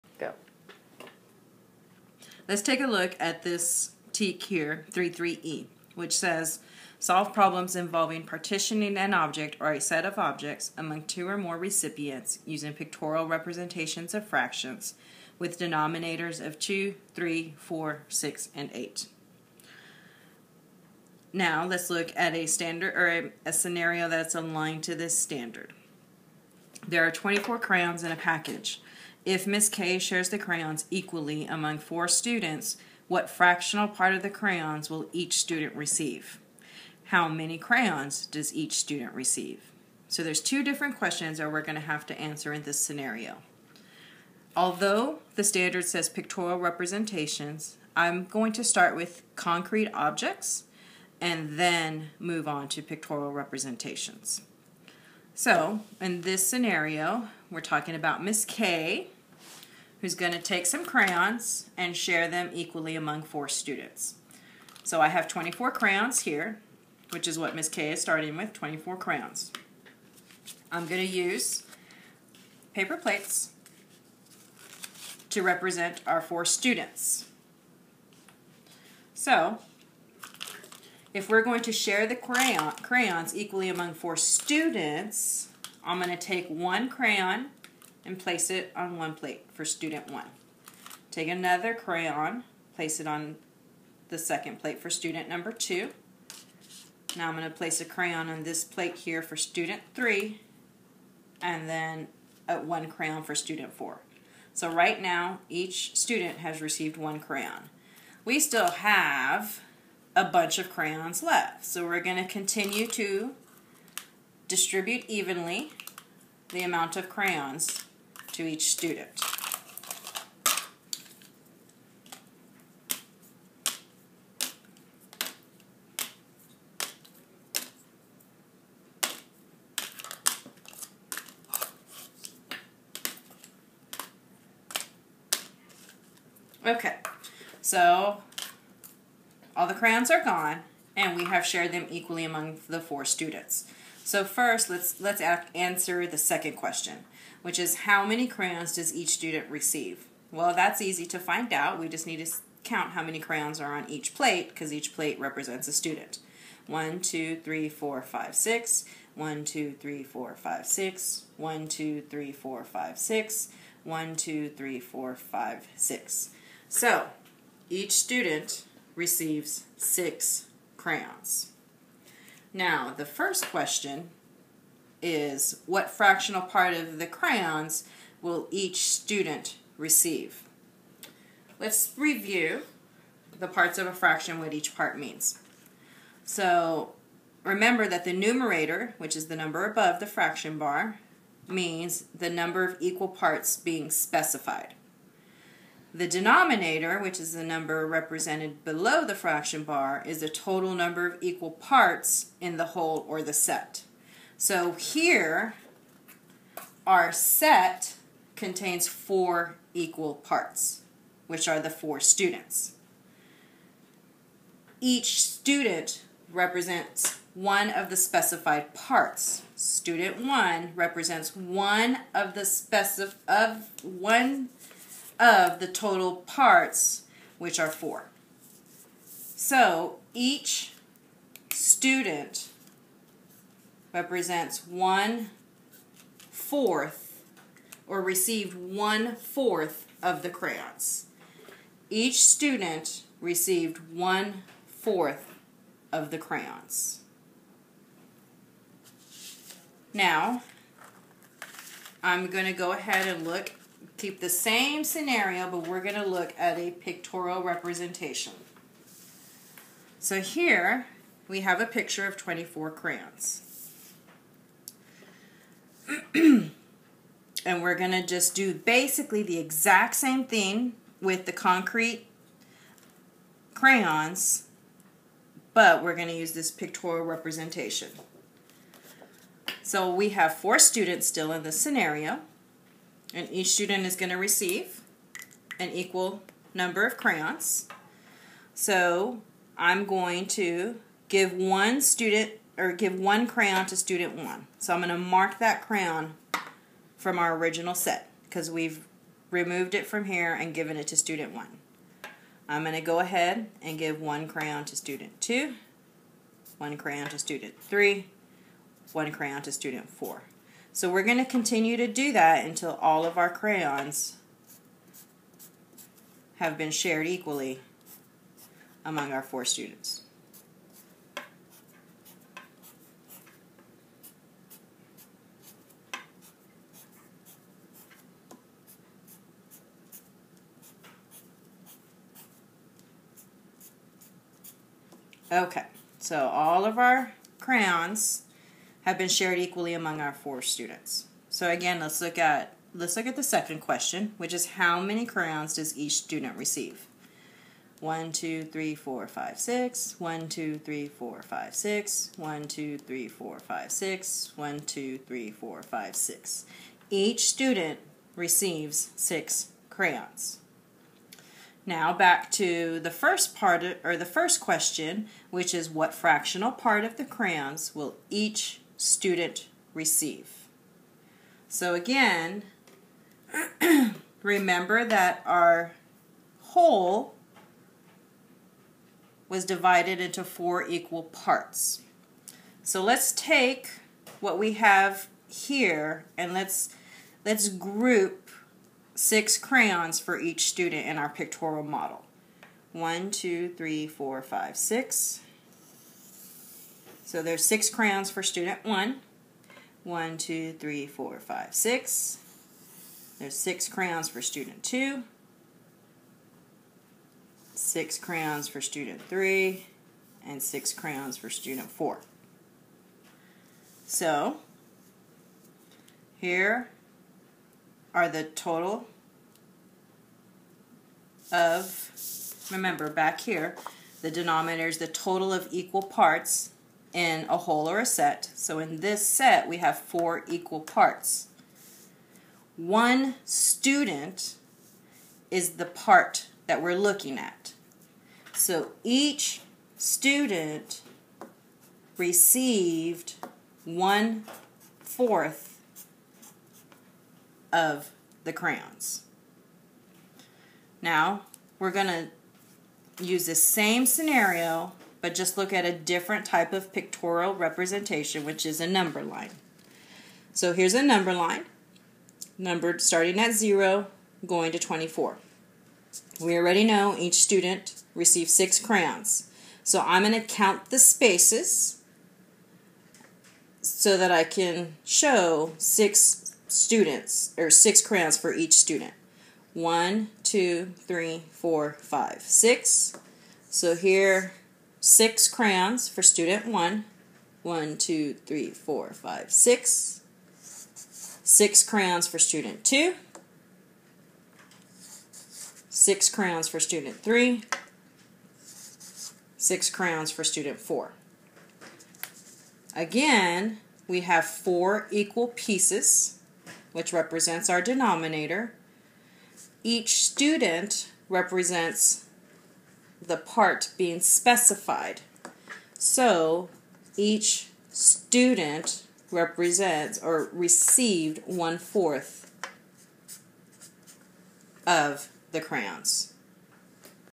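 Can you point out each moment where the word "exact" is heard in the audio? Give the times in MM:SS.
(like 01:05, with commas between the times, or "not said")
04:29.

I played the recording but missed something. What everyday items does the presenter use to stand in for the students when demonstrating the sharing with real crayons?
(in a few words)
paper plates.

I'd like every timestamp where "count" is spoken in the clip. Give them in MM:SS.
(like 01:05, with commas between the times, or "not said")
02:32, 07:50.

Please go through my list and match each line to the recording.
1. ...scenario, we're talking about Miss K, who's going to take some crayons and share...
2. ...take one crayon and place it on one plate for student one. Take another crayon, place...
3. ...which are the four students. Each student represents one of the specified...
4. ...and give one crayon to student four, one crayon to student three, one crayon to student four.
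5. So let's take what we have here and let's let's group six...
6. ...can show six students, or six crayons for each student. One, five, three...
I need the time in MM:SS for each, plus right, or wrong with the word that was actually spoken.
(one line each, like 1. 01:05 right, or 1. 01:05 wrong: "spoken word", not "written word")
1. 00:56 right
2. 01:26 right
3. 03:31 right
4. 05:03 wrong: "two", not "four"
5. 06:22 right
6. 07:54 wrong: "two", not "five".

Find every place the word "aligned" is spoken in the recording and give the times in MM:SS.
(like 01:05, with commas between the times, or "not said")
00:24.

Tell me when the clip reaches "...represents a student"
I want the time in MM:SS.
02:35.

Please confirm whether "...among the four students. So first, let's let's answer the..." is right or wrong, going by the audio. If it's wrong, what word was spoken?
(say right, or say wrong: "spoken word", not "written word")
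right.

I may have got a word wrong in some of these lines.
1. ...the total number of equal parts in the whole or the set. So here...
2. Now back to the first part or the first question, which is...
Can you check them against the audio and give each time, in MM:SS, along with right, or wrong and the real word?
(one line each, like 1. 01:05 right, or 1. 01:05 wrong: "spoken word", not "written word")
1. 03:20 right
2. 06:01 right.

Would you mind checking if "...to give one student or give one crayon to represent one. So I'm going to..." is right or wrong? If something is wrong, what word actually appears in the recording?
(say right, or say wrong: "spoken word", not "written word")
wrong: "student", not "represent".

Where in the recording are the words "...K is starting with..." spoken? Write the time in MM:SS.
01:07.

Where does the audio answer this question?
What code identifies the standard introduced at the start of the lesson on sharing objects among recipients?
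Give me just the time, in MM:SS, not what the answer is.
00:04.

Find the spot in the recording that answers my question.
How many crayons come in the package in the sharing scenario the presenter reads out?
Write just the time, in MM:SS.
00:27.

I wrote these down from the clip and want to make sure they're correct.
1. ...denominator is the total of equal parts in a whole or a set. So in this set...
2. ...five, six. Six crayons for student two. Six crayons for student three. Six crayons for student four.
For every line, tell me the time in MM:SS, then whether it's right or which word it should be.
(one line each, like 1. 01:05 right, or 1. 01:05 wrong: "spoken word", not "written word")
1. 07:04 right
2. 08:08 right.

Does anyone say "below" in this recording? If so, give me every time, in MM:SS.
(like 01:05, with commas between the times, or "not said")
03:18.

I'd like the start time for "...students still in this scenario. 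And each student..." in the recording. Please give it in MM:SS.
04:40.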